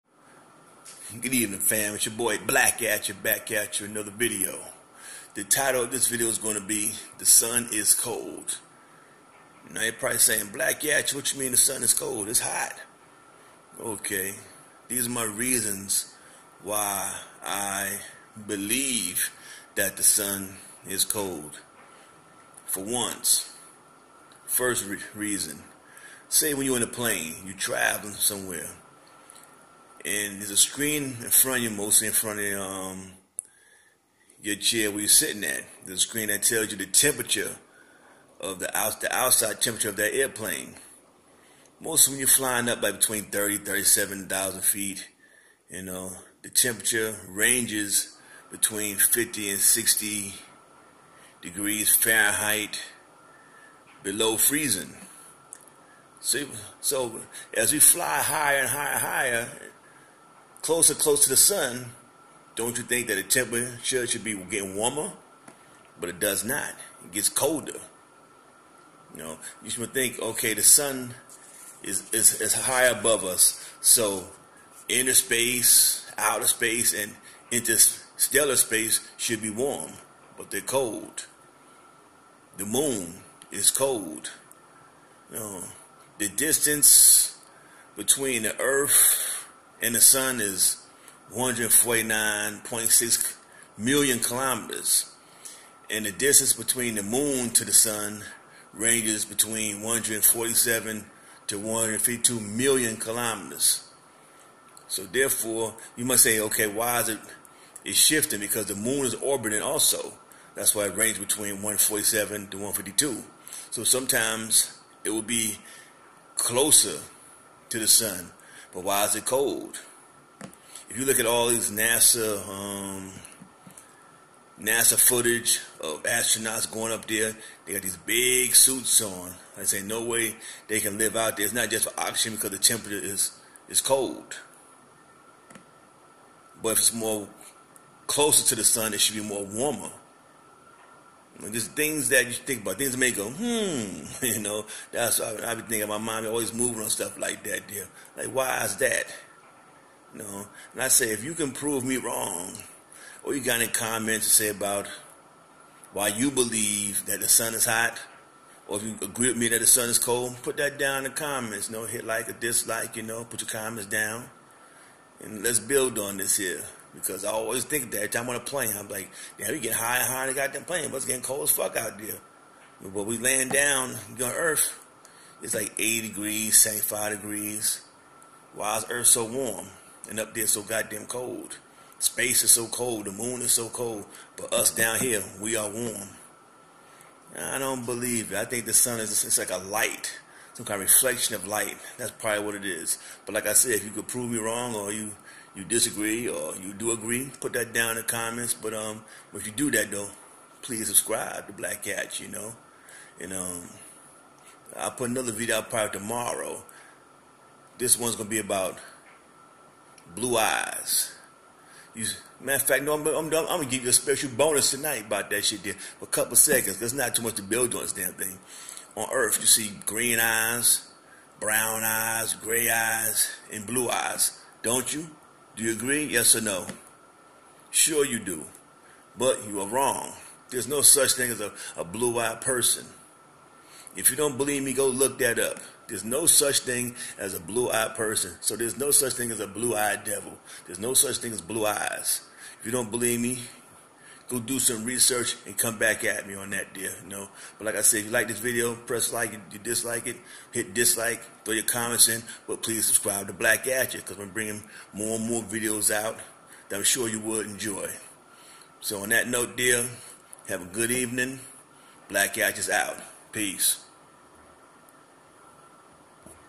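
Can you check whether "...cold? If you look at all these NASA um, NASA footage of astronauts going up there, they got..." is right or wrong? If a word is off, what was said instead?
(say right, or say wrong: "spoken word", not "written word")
right.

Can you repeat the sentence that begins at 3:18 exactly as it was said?
But um, if you do that though, please subscribe to Blackatcha, you know.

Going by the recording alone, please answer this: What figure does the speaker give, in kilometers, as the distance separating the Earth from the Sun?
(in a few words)
149.6 million kilometers.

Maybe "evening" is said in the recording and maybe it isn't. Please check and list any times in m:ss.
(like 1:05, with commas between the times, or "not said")
0:01, 4:20.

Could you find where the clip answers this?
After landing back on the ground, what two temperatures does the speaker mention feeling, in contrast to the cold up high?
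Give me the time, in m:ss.
2:55.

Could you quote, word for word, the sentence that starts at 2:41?
You know, hit like or dislike.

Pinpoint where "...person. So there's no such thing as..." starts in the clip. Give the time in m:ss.
3:57.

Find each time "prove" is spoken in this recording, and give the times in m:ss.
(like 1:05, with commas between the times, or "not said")
2:31, 3:14.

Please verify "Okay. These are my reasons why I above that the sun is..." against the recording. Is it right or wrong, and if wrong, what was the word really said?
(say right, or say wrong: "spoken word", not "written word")
wrong: "believe", not "above".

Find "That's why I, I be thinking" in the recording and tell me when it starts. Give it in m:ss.
2:24.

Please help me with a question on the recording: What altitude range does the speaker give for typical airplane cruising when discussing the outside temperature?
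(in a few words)
30 to 37,000 feet.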